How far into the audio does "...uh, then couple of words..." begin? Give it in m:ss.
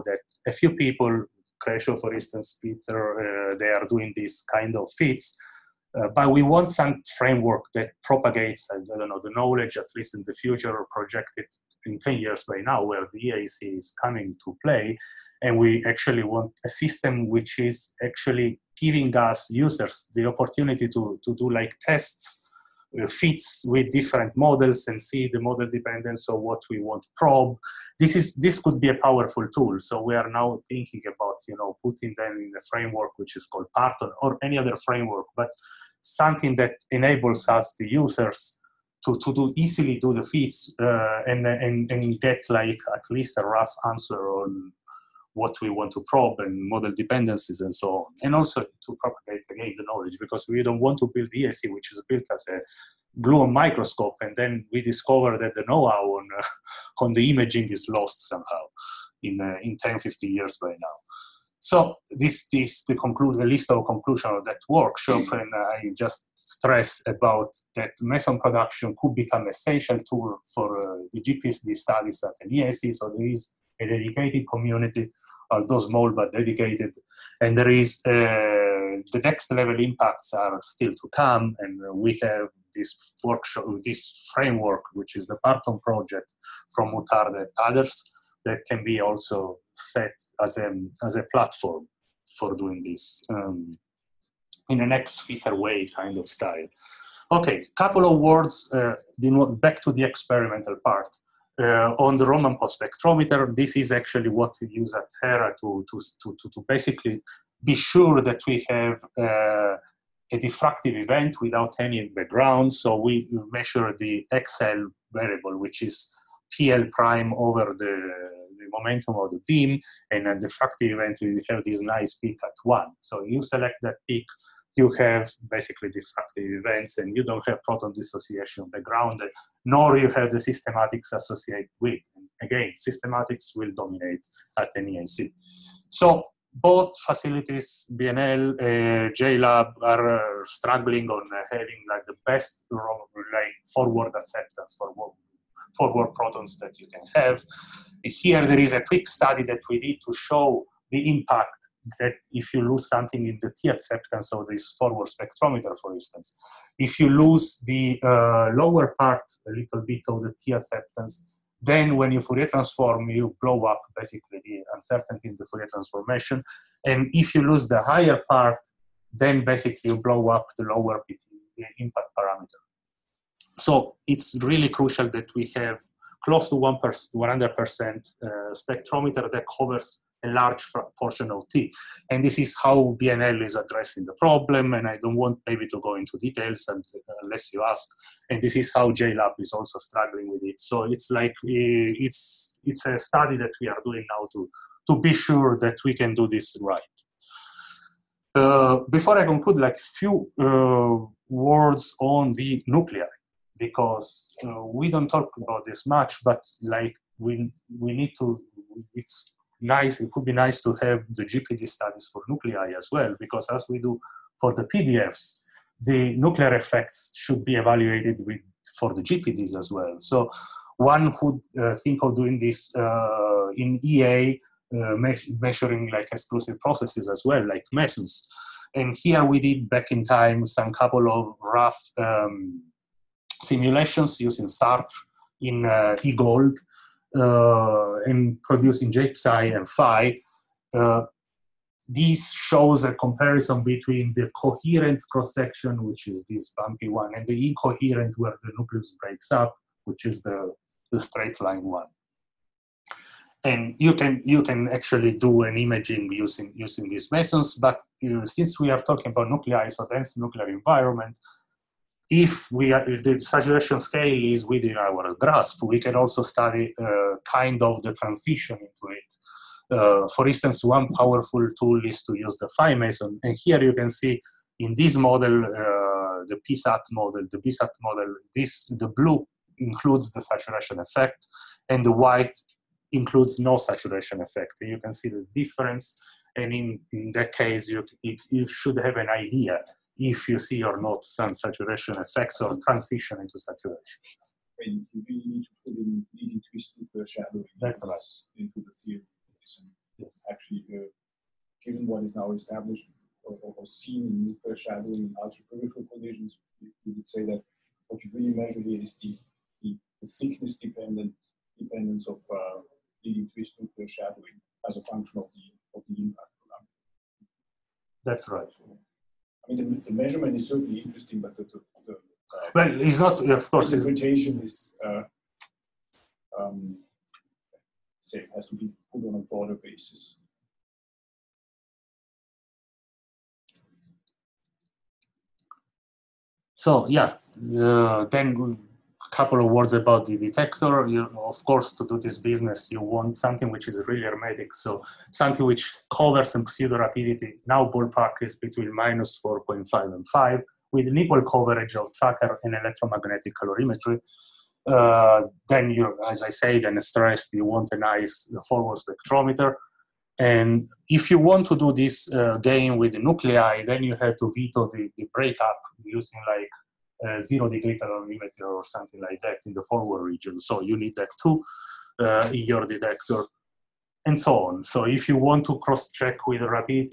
5:37.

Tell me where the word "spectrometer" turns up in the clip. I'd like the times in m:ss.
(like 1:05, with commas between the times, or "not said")
1:42, 2:35, 2:58, 5:58.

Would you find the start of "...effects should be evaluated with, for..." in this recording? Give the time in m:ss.
3:36.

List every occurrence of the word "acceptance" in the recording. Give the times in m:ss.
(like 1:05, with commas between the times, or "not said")
2:24, 2:33, 2:40.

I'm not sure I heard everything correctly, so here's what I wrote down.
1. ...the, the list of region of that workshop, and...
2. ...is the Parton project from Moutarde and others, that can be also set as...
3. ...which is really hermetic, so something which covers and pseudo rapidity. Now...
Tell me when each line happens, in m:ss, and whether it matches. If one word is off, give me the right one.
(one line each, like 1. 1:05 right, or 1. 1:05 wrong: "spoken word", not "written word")
1. 1:02 wrong: "conclusion", not "region"
2. 1:25 right
3. 5:43 right.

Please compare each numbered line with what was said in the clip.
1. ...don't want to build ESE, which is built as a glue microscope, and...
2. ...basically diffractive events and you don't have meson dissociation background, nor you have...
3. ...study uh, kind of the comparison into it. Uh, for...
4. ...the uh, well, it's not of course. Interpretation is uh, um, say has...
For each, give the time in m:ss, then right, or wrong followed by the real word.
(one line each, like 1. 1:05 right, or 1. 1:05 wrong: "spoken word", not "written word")
1. 0:50 right
2. 2:05 wrong: "proton", not "meson"
3. 4:26 wrong: "transition", not "comparison"
4. 5:21 right.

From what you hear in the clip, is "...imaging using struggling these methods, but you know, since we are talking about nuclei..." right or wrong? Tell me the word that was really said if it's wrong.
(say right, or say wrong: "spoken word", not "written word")
wrong: "using", not "struggling".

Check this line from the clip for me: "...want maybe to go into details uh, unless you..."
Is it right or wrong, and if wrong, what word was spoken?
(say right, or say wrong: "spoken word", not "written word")
right.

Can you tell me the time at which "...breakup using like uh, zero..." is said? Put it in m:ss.
6:05.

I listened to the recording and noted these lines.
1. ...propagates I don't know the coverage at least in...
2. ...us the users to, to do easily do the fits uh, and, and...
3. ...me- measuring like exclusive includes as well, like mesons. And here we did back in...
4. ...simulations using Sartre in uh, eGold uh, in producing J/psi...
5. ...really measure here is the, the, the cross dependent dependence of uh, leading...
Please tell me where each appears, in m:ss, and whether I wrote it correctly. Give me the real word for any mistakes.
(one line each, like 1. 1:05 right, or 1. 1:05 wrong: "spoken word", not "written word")
1. 0:08 wrong: "knowledge", not "coverage"
2. 0:37 right
3. 3:44 wrong: "processes", not "includes"
4. 3:53 right
5. 5:08 wrong: "thickness", not "cross".